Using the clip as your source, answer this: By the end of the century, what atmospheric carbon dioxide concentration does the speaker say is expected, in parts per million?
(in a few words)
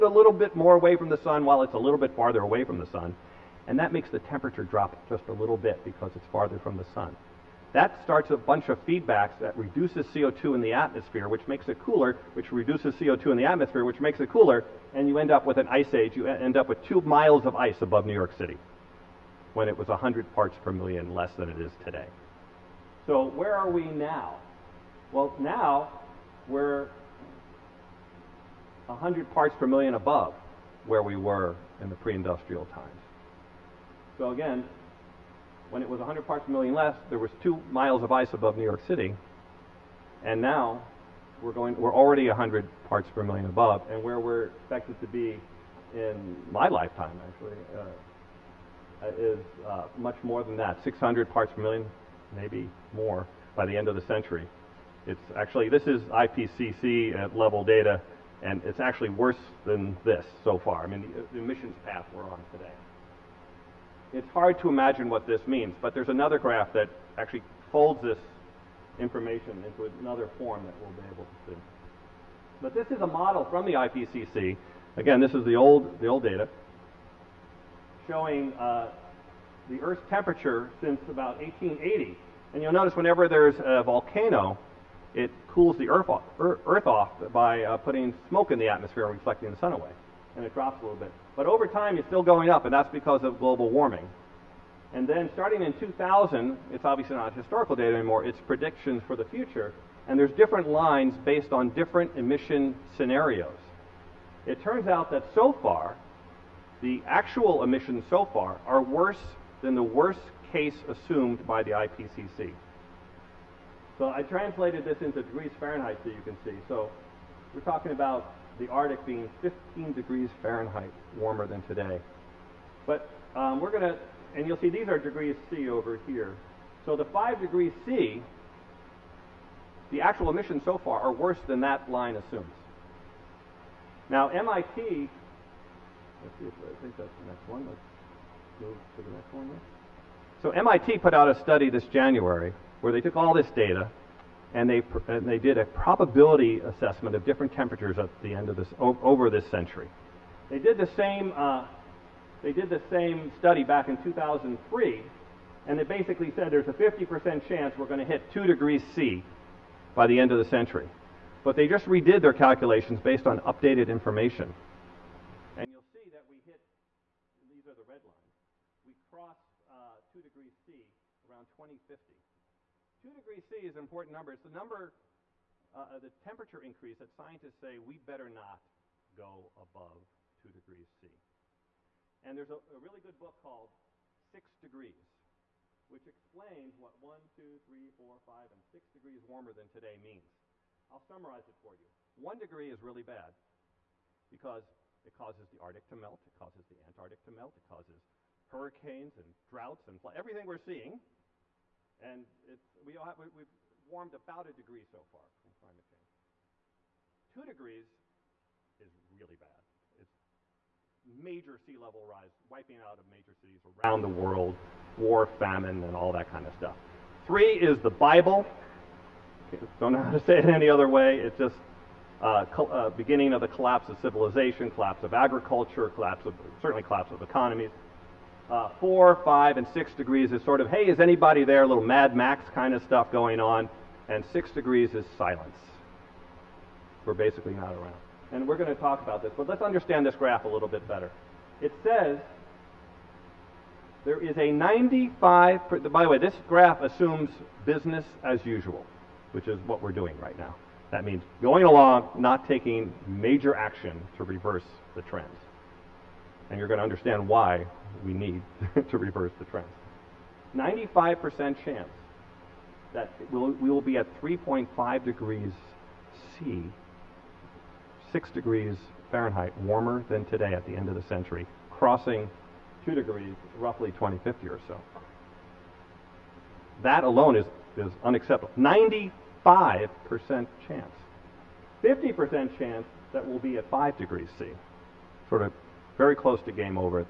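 600.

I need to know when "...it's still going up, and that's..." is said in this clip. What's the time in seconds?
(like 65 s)
91 s.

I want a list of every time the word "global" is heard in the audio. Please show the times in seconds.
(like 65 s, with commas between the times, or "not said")
93 s.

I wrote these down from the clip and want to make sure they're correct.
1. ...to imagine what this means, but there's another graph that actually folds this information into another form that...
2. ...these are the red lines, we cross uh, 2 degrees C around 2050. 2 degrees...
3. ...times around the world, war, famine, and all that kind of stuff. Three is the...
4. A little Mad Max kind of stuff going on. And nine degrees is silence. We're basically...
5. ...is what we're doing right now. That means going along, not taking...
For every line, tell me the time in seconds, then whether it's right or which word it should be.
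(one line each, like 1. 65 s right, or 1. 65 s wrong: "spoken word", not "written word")
1. 64 s right
2. 167 s right
3. 213 s wrong: "cities", not "times"
4. 231 s wrong: "six", not "nine"
5. 249 s right.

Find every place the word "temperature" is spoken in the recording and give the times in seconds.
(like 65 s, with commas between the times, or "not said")
4 s, 80 s, 147 s, 176 s.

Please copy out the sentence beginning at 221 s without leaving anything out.
It's just uh, uh, beginning of the collapse of civilization, collapse of agriculture, collapse of certainly collapse of economies.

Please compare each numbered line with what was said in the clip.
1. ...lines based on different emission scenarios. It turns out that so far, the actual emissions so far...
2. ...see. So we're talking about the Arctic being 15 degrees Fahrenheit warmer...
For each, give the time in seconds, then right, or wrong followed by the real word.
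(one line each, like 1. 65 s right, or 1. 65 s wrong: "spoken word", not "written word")
1. 100 s right
2. 116 s right.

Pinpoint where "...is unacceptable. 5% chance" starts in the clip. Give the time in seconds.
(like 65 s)
277 s.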